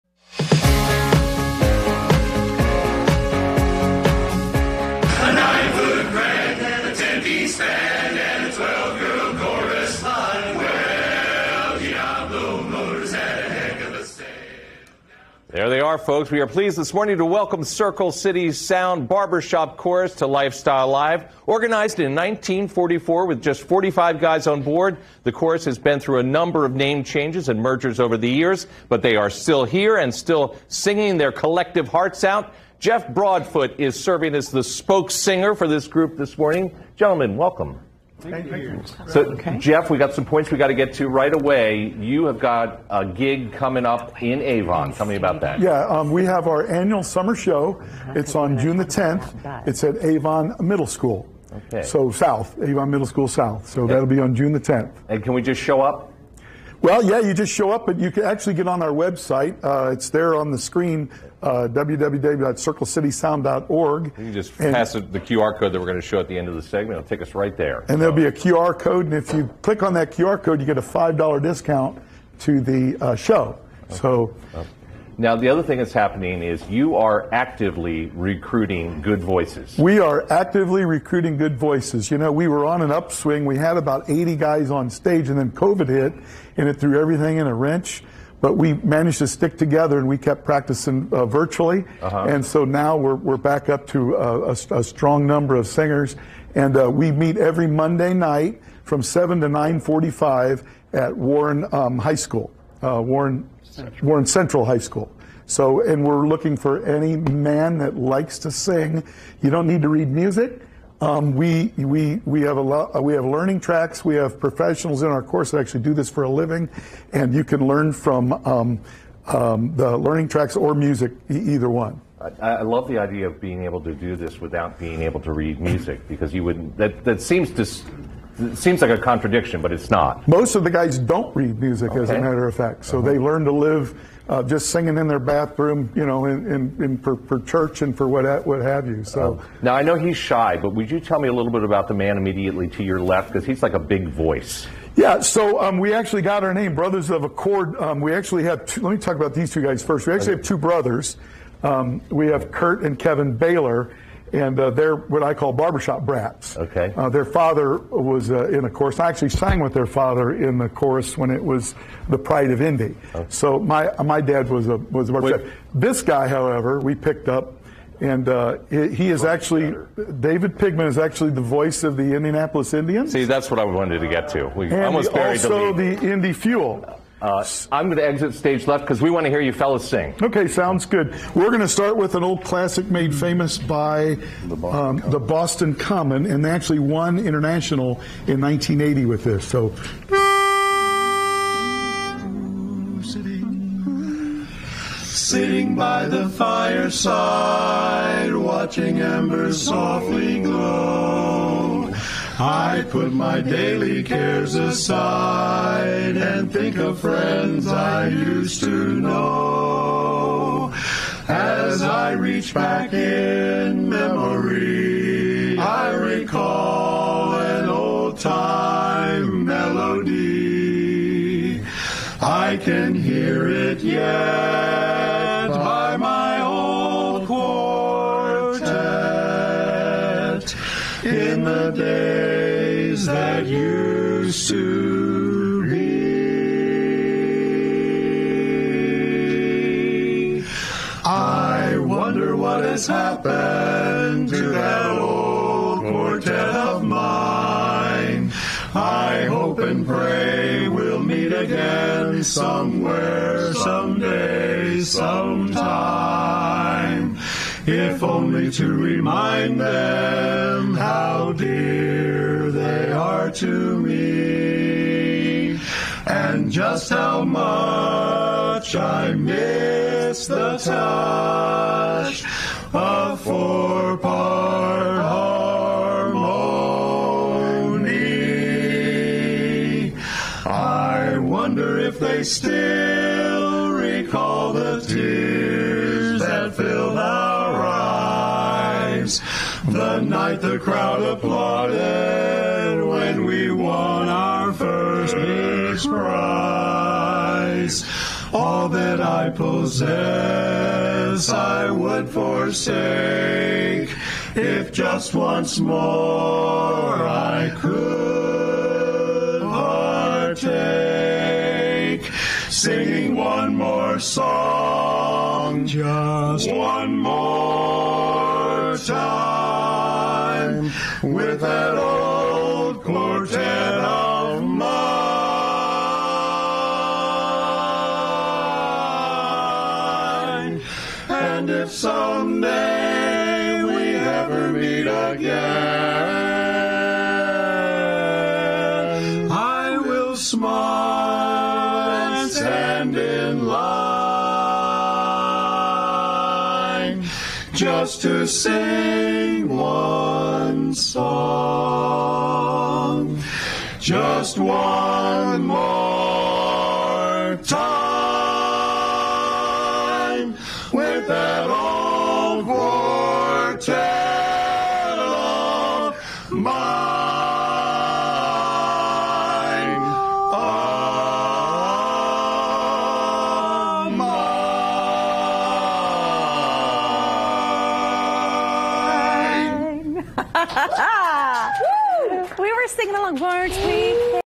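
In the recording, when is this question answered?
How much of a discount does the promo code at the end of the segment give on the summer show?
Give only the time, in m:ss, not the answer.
1:10.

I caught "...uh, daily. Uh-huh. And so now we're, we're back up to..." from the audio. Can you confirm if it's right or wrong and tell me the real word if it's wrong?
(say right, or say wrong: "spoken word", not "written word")
wrong: "virtually", not "daily".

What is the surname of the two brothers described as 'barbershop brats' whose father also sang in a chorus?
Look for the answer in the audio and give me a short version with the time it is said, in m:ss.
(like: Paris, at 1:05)
Baylor, at 2:33.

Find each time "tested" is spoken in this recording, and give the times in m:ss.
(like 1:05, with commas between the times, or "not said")
not said.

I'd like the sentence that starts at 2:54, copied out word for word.
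We and almost buried also the, lead.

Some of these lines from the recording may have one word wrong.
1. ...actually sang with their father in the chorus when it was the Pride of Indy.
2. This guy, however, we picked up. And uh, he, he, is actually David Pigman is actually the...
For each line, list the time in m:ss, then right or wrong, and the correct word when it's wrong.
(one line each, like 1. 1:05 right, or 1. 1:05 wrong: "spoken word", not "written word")
1. 2:39 right
2. 2:45 right.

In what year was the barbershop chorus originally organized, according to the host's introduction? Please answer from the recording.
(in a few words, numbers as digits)
1944.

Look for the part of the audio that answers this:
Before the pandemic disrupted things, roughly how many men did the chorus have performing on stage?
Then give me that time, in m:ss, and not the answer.
1:24.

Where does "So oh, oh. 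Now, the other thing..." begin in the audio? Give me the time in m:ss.
1:13.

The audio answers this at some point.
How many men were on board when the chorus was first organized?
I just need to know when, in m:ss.
0:23.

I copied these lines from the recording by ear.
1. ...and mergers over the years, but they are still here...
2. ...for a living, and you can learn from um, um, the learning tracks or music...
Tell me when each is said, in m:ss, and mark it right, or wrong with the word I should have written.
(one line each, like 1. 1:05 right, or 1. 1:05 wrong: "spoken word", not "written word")
1. 0:27 right
2. 1:56 right.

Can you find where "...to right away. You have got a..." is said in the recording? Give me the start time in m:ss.
0:40.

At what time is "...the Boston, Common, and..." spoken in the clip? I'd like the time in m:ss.
3:05.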